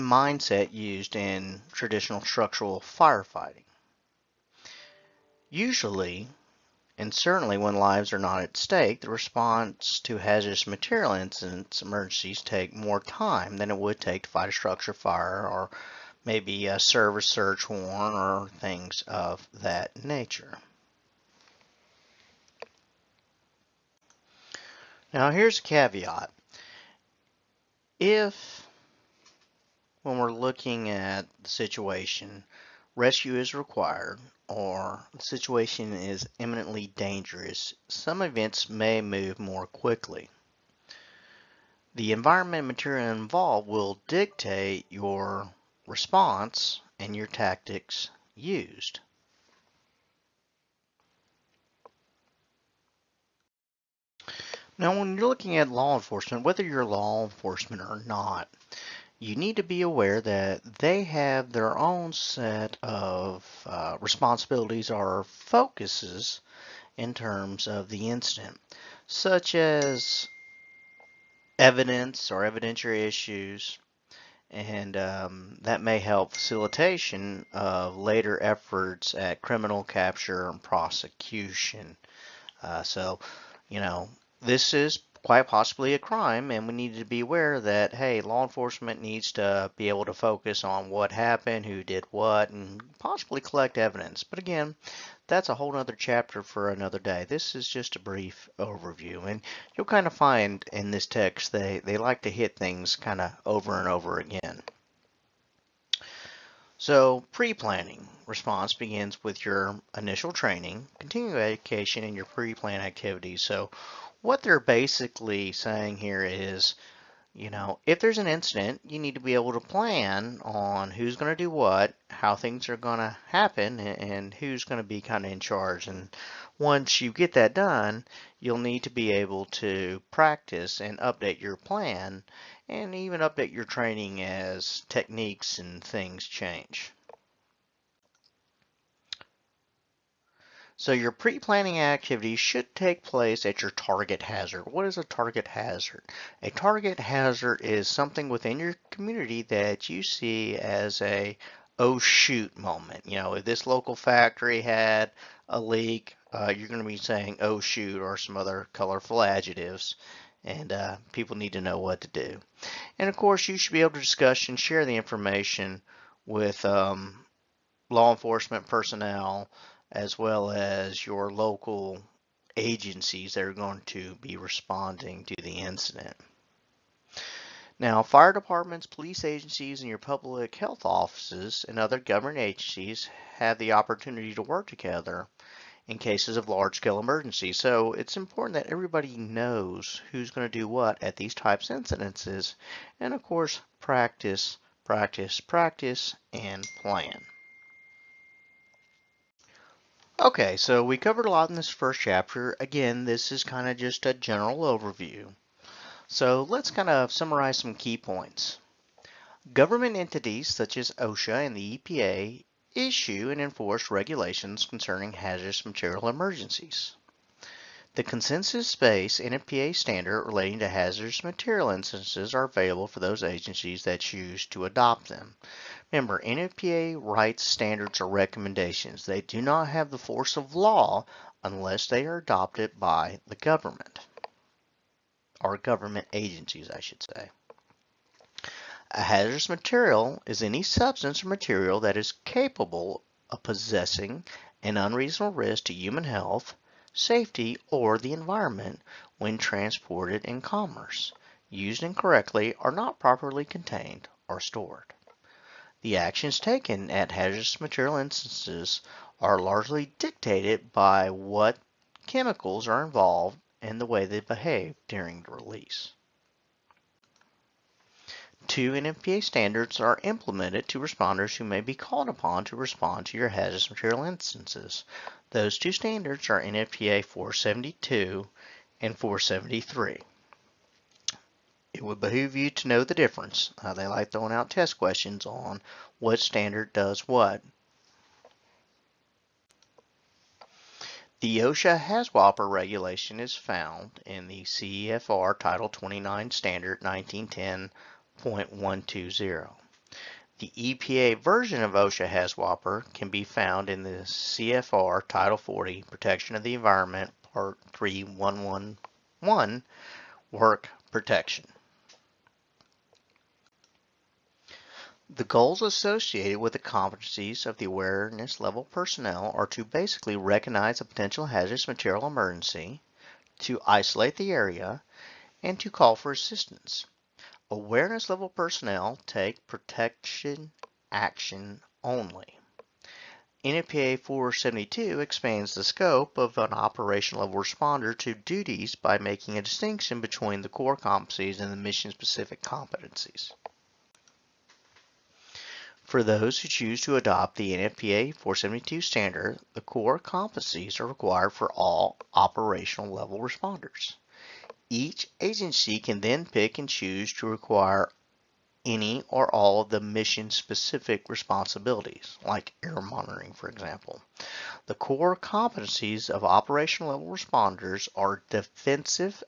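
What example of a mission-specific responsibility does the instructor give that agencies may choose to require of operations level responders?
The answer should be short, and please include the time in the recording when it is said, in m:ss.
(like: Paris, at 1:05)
Air monitoring, at 6:02.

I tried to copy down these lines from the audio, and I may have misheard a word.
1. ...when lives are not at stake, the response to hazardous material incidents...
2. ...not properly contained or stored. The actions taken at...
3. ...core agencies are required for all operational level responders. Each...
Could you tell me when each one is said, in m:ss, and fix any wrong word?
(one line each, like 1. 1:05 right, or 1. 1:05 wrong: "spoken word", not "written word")
1. 0:07 right
2. 4:12 right
3. 5:49 wrong: "competencies", not "agencies".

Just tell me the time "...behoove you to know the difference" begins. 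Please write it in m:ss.
4:41.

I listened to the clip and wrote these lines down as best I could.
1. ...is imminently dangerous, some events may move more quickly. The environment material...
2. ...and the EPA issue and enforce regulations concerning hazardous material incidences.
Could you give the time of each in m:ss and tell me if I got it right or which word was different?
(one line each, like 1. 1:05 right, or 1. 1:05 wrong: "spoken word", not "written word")
1. 0:35 right
2. 3:31 wrong: "emergencies", not "incidences".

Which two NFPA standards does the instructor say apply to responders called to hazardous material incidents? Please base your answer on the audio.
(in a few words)
NFPA 472 and 473.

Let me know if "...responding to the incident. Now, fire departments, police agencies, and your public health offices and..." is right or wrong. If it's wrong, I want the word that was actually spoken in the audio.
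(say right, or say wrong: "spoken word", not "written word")
right.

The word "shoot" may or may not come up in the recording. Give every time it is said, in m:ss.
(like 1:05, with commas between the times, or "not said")
2:31, 2:37.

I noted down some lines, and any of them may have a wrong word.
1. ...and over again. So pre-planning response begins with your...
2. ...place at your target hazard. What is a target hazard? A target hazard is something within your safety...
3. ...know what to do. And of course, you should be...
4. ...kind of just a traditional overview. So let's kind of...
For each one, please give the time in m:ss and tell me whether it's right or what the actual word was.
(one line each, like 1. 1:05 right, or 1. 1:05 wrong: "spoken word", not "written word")
1. 1:43 right
2. 2:23 wrong: "community", not "safety"
3. 2:41 right
4. 3:23 wrong: "general", not "traditional".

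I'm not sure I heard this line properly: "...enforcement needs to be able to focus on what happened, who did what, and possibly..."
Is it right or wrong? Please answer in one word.
right.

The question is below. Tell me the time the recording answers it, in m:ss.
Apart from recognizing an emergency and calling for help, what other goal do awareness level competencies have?
5:23.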